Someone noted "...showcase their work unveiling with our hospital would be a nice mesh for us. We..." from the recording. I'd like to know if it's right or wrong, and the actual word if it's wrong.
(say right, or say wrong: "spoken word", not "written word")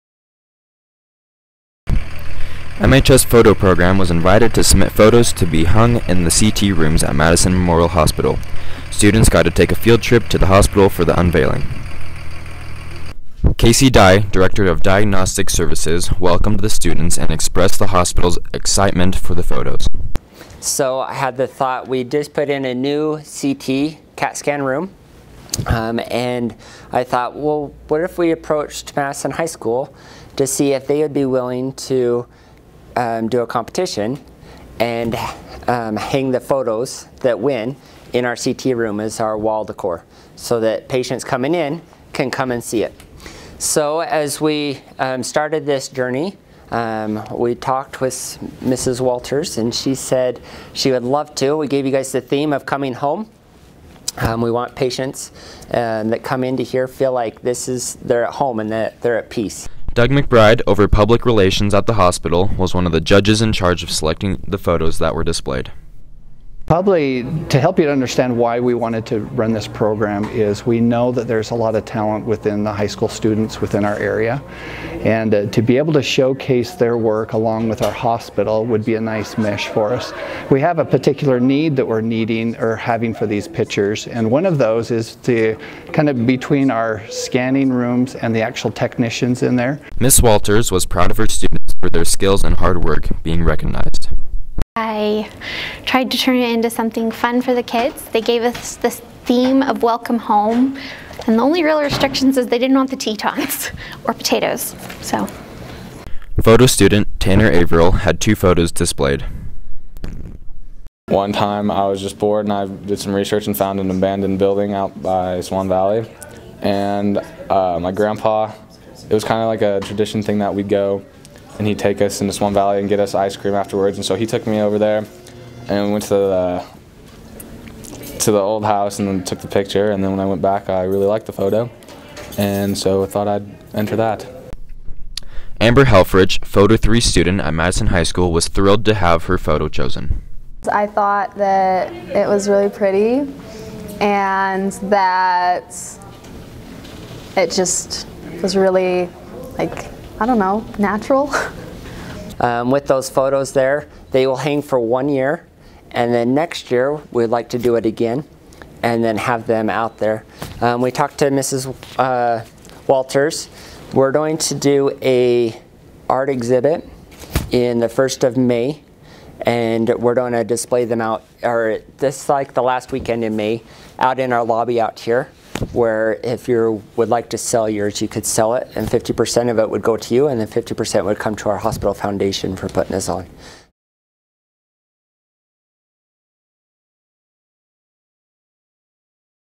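wrong: "along", not "unveiling".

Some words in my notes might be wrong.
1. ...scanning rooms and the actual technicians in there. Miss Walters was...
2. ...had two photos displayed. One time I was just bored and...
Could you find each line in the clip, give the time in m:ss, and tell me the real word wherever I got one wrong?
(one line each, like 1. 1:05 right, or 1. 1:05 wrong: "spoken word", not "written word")
1. 1:27 right
2. 1:47 right.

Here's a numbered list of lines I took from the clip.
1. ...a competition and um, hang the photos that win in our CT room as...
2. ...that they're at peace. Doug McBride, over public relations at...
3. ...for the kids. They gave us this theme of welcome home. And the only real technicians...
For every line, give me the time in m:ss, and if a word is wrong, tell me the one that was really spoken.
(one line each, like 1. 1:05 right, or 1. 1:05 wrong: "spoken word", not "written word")
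1. 0:33 right
2. 0:58 right
3. 1:37 wrong: "restrictions", not "technicians".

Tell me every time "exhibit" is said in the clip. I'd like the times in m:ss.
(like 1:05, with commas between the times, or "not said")
2:46.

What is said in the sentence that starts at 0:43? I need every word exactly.
So as we um, started this journey, um, we talked with Mrs.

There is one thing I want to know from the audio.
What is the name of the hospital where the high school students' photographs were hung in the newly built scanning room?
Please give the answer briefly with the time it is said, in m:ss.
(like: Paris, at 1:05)
Madison Memorial Hospital, at 0:07.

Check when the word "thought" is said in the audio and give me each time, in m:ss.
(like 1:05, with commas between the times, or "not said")
0:21, 0:27, 2:13, 2:20.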